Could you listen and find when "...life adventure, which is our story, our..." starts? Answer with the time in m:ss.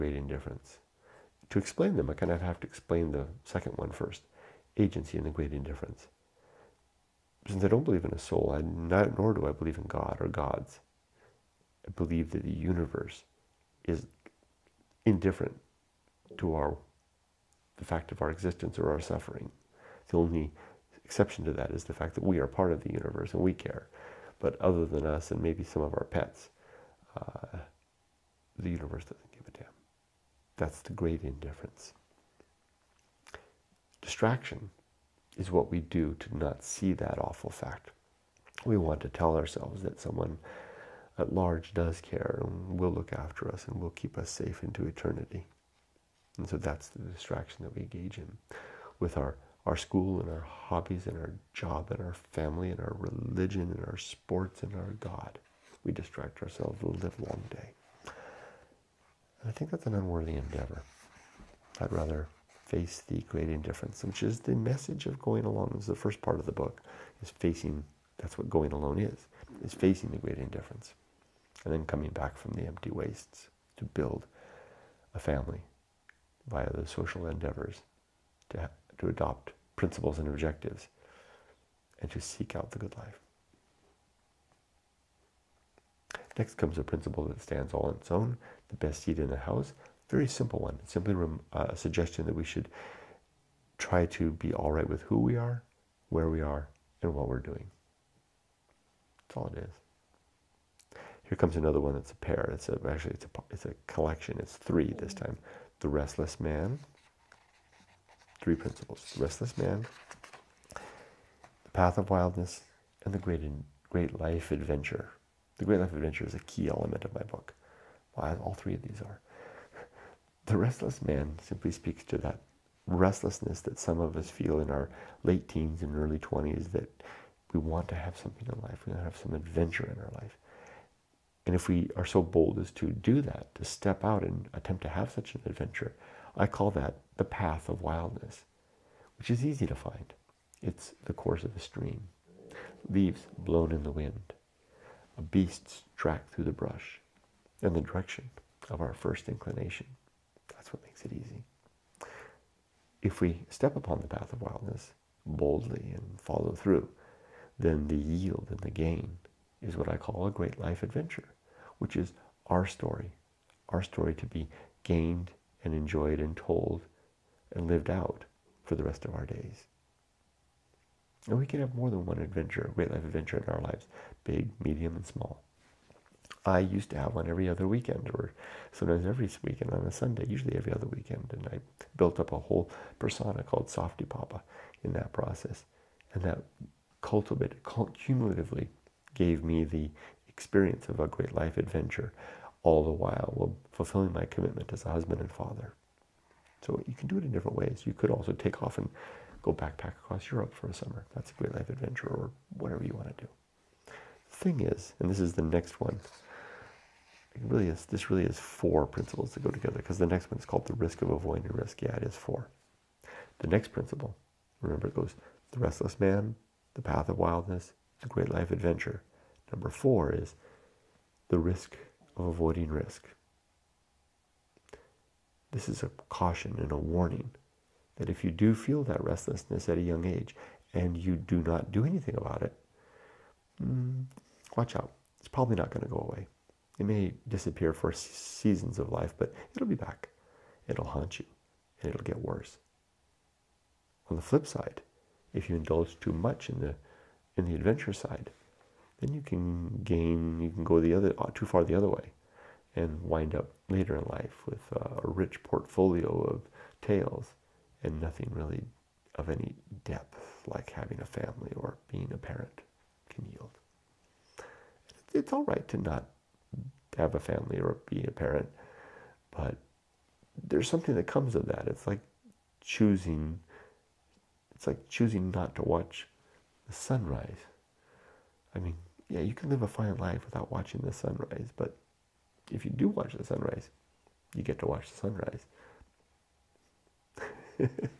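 2:40.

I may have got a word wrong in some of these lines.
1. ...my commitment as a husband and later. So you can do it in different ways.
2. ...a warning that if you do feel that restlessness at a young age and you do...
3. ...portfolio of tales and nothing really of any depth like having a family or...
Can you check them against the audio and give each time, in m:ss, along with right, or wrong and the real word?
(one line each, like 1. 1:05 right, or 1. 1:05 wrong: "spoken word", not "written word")
1. 3:14 wrong: "father", not "later"
2. 3:46 right
3. 4:15 right.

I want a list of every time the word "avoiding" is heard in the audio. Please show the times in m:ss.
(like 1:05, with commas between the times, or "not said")
3:31, 3:42.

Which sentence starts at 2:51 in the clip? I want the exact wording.
And we can have more than one adventure, great life adventure in our lives, big, medium, and small.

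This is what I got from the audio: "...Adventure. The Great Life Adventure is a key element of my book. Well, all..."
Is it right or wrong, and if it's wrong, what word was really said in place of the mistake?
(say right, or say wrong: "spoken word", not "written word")
right.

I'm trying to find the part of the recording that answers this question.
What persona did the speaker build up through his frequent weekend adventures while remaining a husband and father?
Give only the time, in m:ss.
3:03.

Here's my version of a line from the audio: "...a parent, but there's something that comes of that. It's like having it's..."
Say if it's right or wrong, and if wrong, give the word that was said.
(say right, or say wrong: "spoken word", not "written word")
wrong: "choosing", not "having".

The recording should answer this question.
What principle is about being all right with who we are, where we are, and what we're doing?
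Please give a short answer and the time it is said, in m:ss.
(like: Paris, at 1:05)
The best seat in the house, at 1:28.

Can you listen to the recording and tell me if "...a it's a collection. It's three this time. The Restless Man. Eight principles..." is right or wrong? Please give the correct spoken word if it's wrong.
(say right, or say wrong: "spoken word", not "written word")
wrong: "Three", not "Eight".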